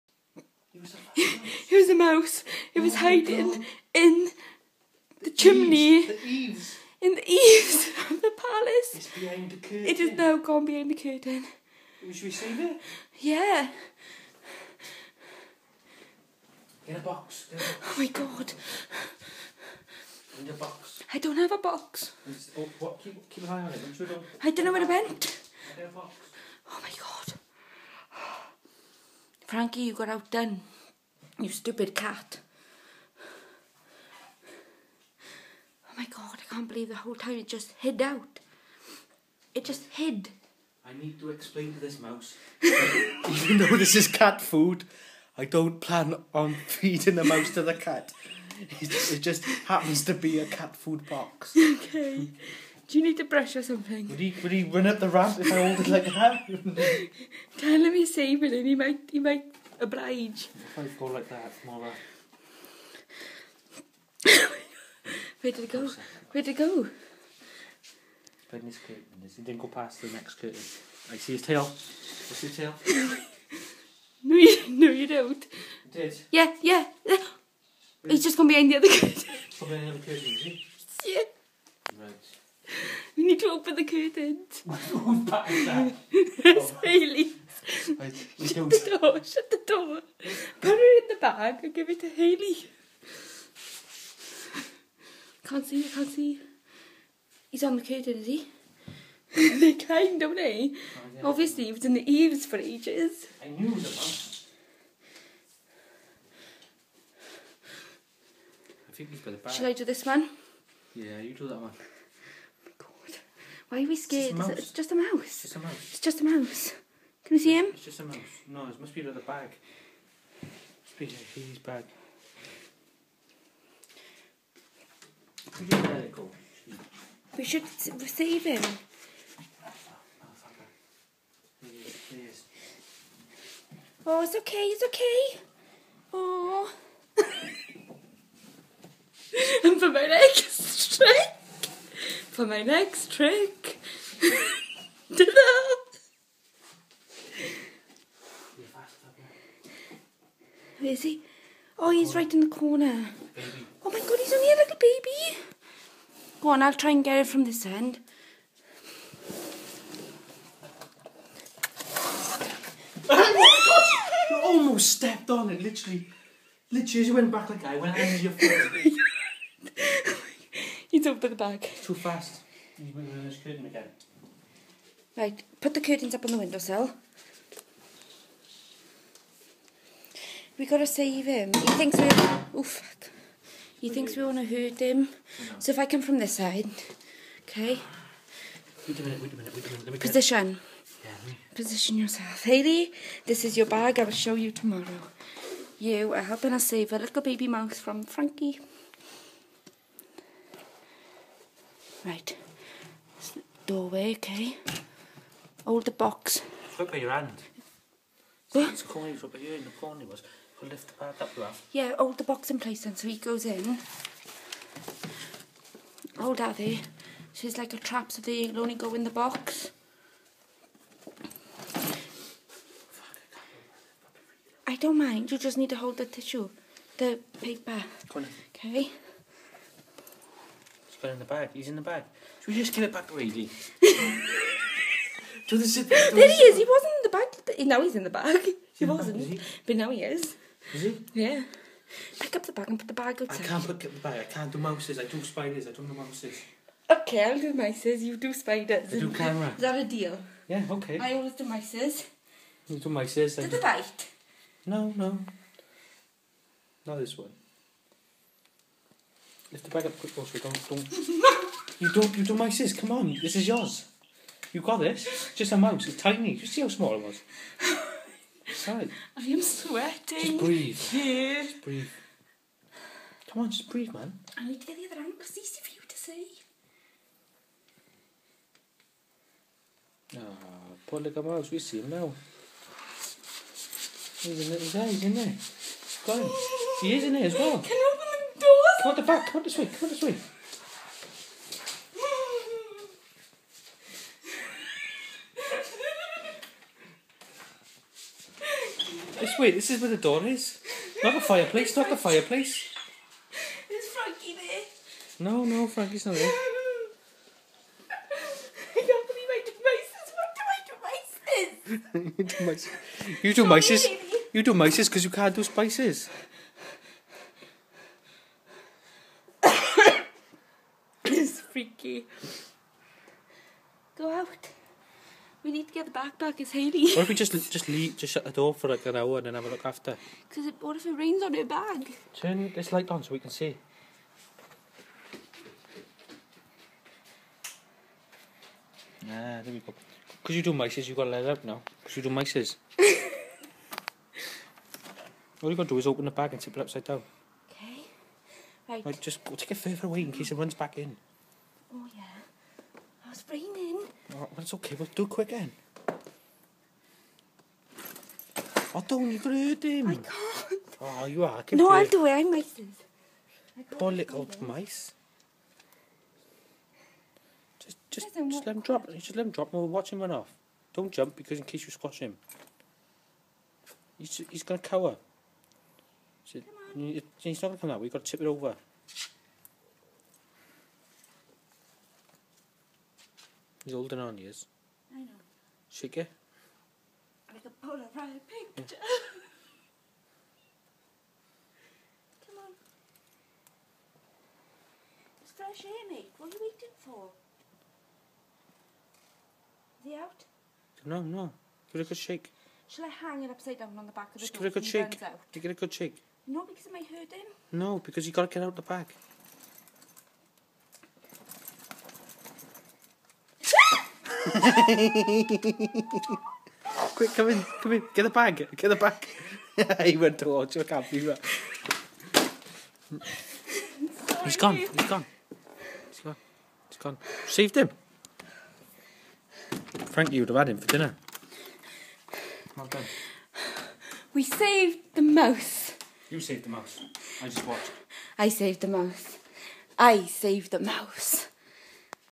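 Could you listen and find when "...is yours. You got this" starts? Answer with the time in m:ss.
4:23.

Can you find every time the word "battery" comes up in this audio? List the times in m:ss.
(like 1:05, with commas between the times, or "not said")
not said.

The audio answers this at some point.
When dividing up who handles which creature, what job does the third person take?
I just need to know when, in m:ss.
4:09.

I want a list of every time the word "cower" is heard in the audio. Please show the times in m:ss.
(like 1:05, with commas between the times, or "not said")
6:14.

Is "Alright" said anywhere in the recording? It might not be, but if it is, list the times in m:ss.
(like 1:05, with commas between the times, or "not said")
5:54.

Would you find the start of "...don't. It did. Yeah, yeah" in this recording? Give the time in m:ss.
1:15.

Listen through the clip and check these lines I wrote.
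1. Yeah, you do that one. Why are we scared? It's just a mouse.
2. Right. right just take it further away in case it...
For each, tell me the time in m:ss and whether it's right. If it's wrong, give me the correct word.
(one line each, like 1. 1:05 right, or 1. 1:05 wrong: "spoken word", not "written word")
1. 1:50 right
2. 5:48 right.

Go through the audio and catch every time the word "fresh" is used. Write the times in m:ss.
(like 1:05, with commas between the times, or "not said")
6:35.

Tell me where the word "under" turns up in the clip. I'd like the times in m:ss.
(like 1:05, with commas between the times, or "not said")
2:47, 2:53.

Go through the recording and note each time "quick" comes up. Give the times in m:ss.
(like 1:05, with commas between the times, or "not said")
4:19, 5:55, 6:54.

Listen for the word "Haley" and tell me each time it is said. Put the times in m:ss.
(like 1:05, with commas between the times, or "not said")
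1:26, 1:32, 3:12, 5:26.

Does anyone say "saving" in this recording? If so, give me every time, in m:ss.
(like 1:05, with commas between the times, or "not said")
0:58.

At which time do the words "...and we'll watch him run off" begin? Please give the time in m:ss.
6:09.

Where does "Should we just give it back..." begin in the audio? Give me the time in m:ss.
3:52.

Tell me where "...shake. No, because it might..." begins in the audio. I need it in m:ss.
6:45.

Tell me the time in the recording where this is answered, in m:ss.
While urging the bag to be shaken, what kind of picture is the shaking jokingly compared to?
6:27.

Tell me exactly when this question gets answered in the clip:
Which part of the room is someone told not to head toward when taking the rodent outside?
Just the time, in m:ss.
5:01.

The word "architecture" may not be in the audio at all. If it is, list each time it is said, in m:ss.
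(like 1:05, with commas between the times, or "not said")
not said.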